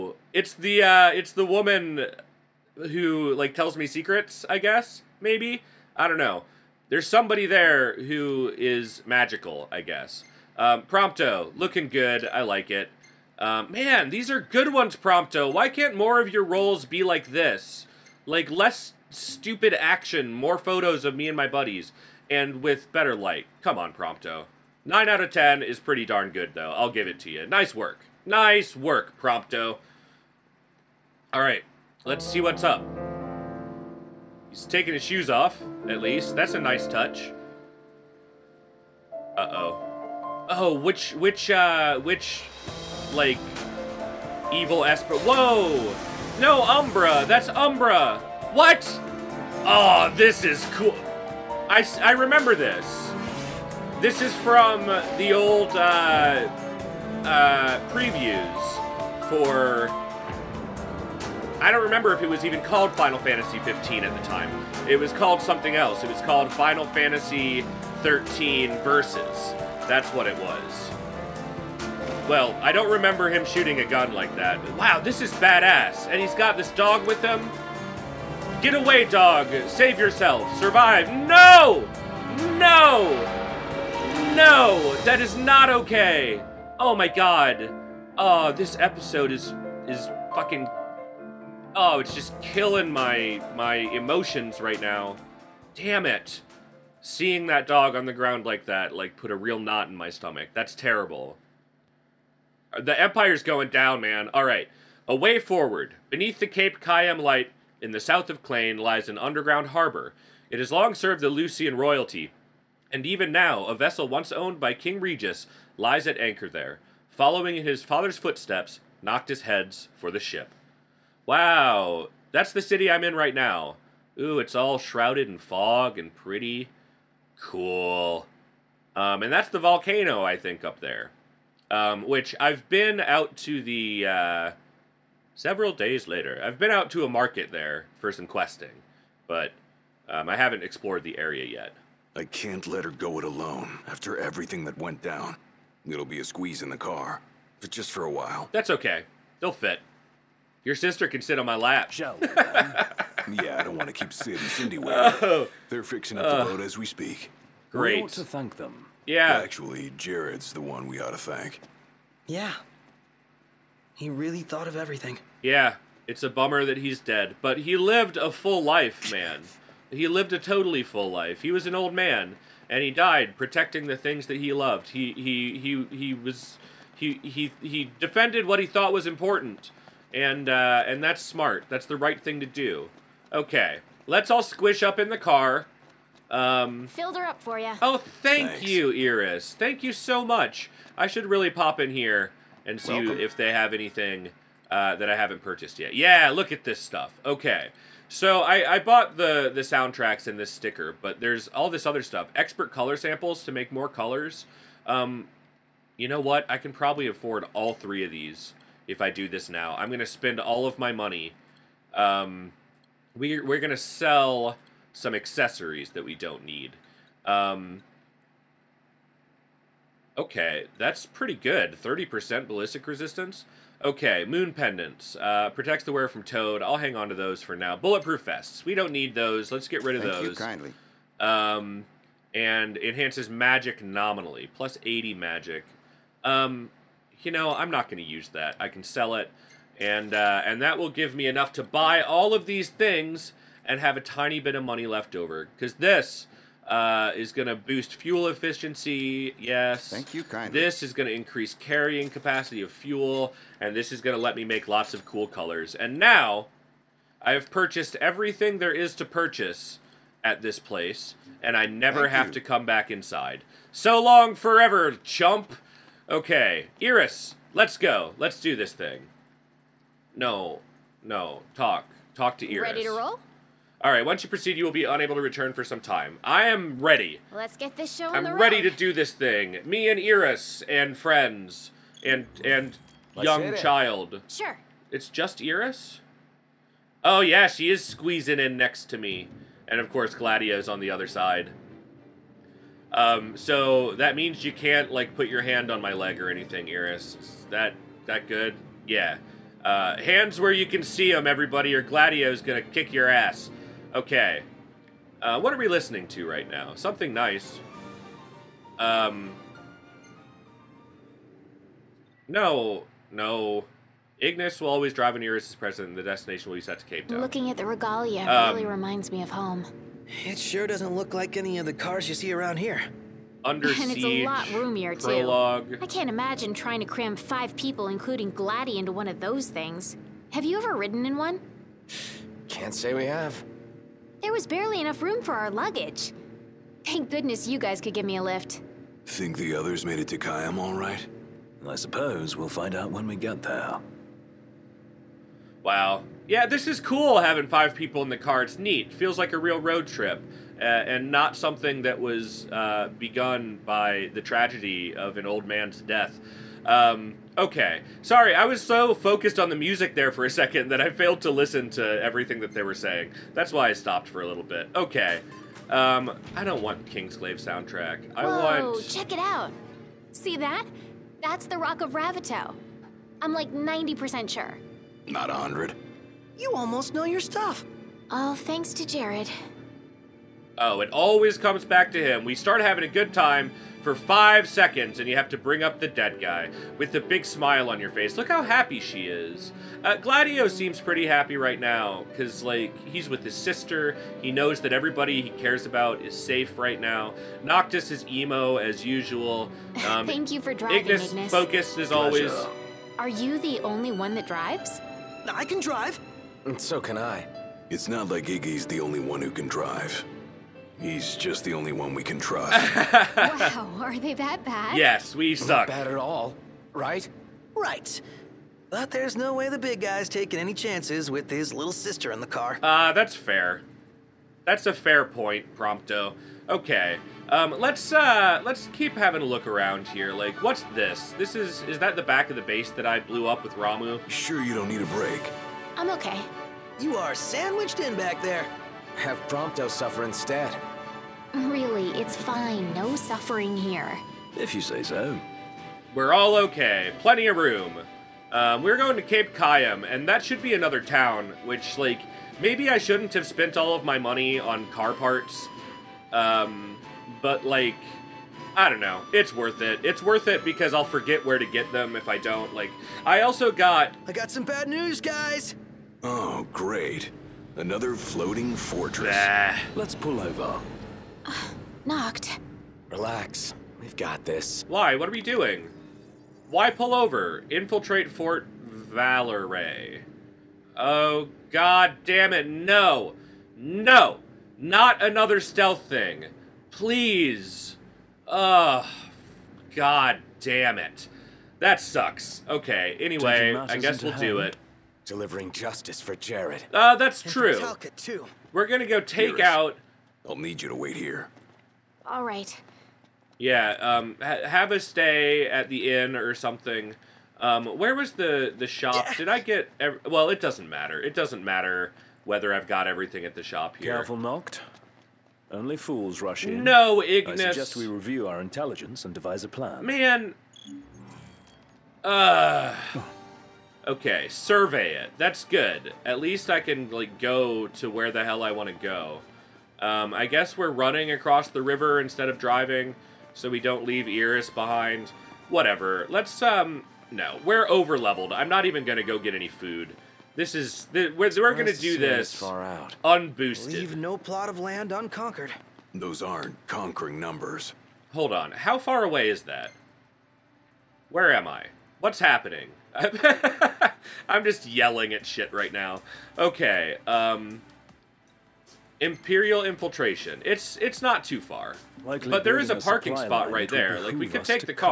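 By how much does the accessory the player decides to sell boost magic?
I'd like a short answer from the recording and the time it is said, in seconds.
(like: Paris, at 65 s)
80, at 234 s.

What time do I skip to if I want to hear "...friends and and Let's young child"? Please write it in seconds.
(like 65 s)
280 s.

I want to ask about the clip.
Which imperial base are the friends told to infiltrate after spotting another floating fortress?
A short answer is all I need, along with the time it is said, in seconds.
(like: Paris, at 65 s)
Fort Vaullerey, at 478 s.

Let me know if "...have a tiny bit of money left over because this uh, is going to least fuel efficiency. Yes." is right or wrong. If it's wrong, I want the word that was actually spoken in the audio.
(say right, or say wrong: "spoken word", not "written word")
wrong: "boost", not "least".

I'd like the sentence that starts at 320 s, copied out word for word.
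It sure doesn't look like any of the cars you see around here and it's a lot roomier prologue.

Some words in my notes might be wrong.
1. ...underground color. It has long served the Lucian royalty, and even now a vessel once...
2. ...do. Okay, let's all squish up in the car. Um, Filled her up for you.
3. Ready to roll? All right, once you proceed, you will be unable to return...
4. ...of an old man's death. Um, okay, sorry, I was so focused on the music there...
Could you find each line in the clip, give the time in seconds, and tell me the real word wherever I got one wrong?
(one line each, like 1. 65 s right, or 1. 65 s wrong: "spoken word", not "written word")
1. 109 s wrong: "harbor", not "color"
2. 182 s right
3. 272 s right
4. 354 s right.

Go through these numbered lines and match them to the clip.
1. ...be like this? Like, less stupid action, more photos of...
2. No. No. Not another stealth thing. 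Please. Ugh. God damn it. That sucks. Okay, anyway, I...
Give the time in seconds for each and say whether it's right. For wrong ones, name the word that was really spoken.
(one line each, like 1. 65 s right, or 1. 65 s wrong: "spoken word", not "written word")
1. 16 s right
2. 482 s right.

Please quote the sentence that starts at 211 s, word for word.
Um, we're, we're going to sell some accessories that we don't need.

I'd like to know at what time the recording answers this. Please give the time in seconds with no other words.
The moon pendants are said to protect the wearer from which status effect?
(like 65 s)
226 s.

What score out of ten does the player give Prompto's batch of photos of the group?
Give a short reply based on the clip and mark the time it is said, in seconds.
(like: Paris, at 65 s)
9, at 24 s.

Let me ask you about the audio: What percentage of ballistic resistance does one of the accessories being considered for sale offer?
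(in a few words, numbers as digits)
30%.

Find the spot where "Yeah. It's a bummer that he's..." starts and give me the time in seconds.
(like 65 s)
165 s.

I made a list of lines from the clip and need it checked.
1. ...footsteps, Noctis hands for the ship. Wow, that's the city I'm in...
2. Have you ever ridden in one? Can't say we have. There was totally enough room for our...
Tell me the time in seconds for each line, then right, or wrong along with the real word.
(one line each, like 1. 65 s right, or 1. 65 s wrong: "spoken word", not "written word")
1. 118 s wrong: "heads", not "hands"
2. 330 s wrong: "barely", not "totally".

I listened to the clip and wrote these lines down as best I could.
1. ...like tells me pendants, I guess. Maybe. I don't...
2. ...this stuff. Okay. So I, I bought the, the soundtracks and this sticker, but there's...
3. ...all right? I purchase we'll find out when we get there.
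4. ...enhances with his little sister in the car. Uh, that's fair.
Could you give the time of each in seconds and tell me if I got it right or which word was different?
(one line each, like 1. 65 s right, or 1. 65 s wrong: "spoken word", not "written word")
1. 3 s wrong: "secrets", not "pendants"
2. 196 s right
3. 340 s wrong: "suppose", not "purchase"
4. 420 s wrong: "chances", not "enhances".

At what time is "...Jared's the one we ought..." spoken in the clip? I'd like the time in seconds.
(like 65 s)
159 s.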